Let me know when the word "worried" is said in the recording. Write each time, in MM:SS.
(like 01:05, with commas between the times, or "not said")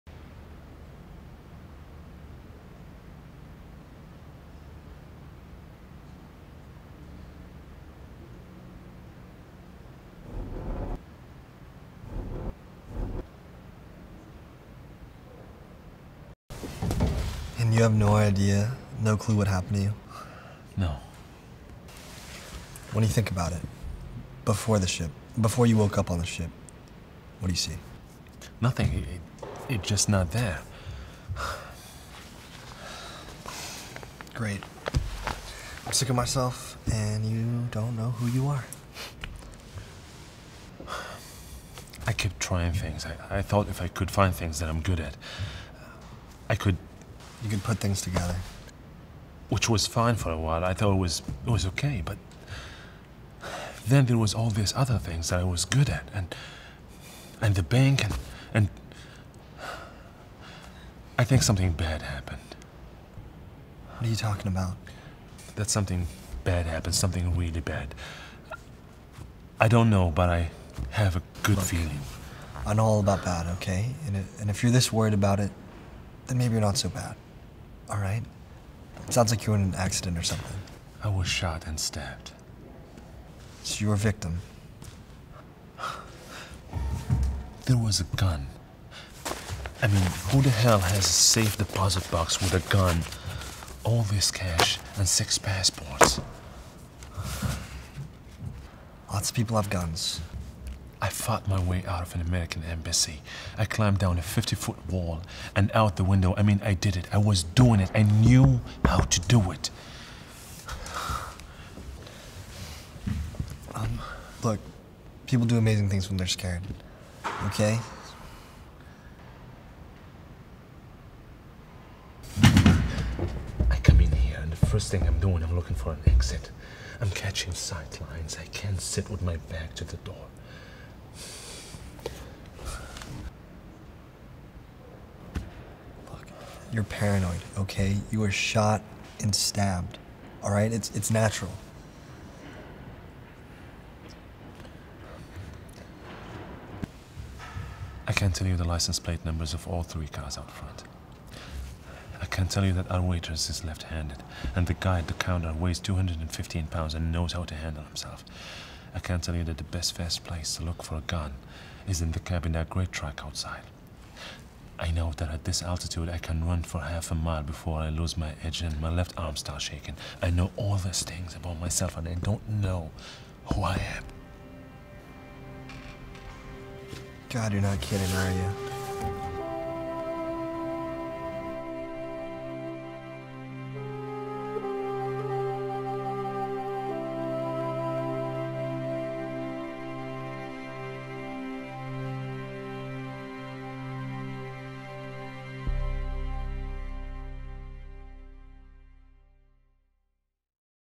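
01:14.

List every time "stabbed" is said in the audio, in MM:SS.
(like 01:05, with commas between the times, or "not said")
01:21, 02:19.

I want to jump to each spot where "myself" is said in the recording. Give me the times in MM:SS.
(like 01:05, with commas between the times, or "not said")
00:36, 02:51.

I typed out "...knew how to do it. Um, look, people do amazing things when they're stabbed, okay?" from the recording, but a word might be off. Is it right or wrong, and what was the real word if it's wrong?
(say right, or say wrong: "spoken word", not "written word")
wrong: "scared", not "stabbed".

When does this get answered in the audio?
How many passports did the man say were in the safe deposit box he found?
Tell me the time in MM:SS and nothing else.
01:35.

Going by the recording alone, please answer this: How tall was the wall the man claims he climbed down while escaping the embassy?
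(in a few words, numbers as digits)
50 feet.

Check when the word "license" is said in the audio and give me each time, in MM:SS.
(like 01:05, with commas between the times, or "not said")
02:28.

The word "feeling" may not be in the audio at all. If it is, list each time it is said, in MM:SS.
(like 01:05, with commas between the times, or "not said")
01:11.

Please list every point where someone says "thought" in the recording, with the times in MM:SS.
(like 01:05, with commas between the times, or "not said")
00:43, 00:50.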